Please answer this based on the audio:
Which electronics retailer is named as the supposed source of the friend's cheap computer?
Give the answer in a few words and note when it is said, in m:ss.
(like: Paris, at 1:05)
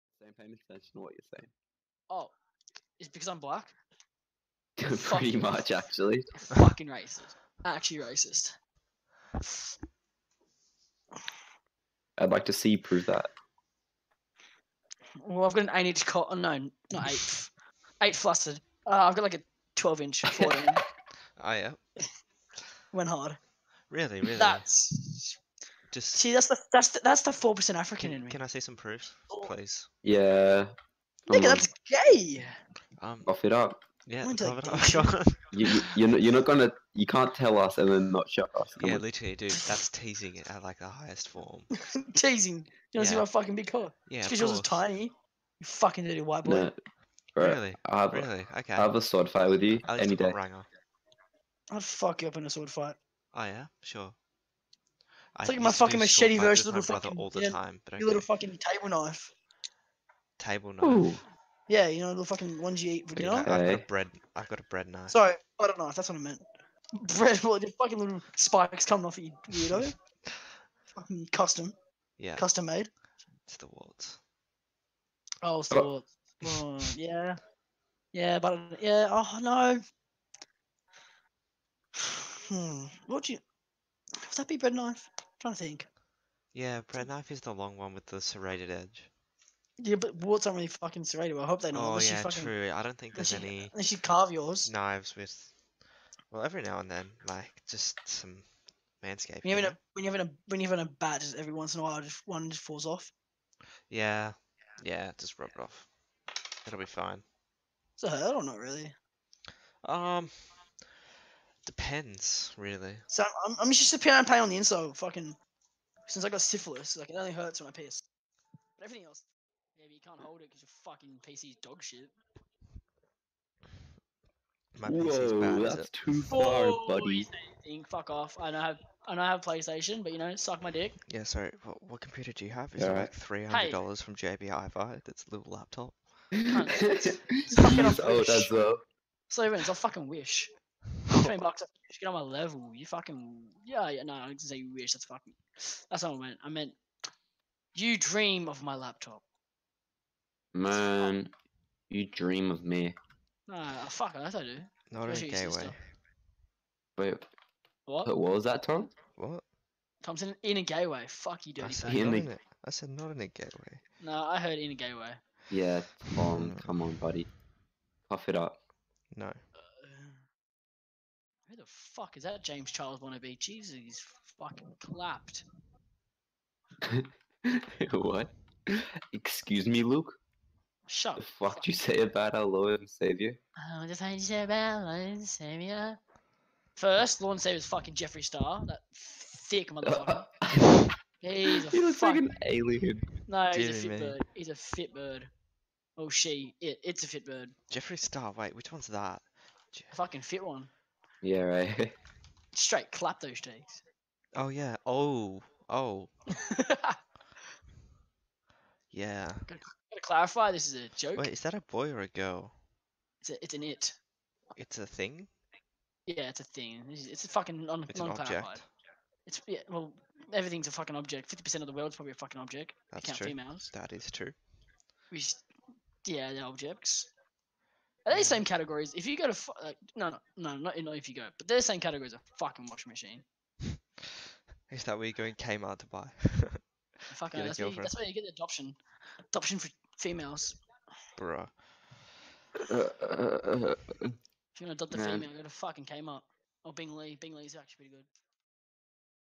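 JB Hi-Fi, at 2:14.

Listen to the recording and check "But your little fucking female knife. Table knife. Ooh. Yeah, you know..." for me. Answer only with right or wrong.
wrong.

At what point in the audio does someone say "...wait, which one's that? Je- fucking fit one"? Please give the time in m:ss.
3:18.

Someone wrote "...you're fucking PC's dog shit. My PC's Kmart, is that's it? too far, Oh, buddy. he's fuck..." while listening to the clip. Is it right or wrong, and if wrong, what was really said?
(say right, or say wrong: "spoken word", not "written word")
wrong: "Whoa", not "Kmart".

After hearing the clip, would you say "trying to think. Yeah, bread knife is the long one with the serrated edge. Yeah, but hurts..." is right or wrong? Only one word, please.
wrong.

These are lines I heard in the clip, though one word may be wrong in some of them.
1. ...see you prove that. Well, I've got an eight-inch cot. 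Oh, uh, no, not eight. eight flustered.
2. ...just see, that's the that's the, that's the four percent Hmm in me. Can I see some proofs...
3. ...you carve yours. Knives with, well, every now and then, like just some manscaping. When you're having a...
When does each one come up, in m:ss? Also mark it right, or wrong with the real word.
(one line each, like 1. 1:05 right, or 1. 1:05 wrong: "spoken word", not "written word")
1. 0:12 right
2. 0:25 wrong: "African", not "Hmm"
3. 1:33 right.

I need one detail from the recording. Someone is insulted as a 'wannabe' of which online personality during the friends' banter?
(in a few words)
James Charles.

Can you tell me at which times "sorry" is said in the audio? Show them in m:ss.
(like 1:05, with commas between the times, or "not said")
1:05, 2:11.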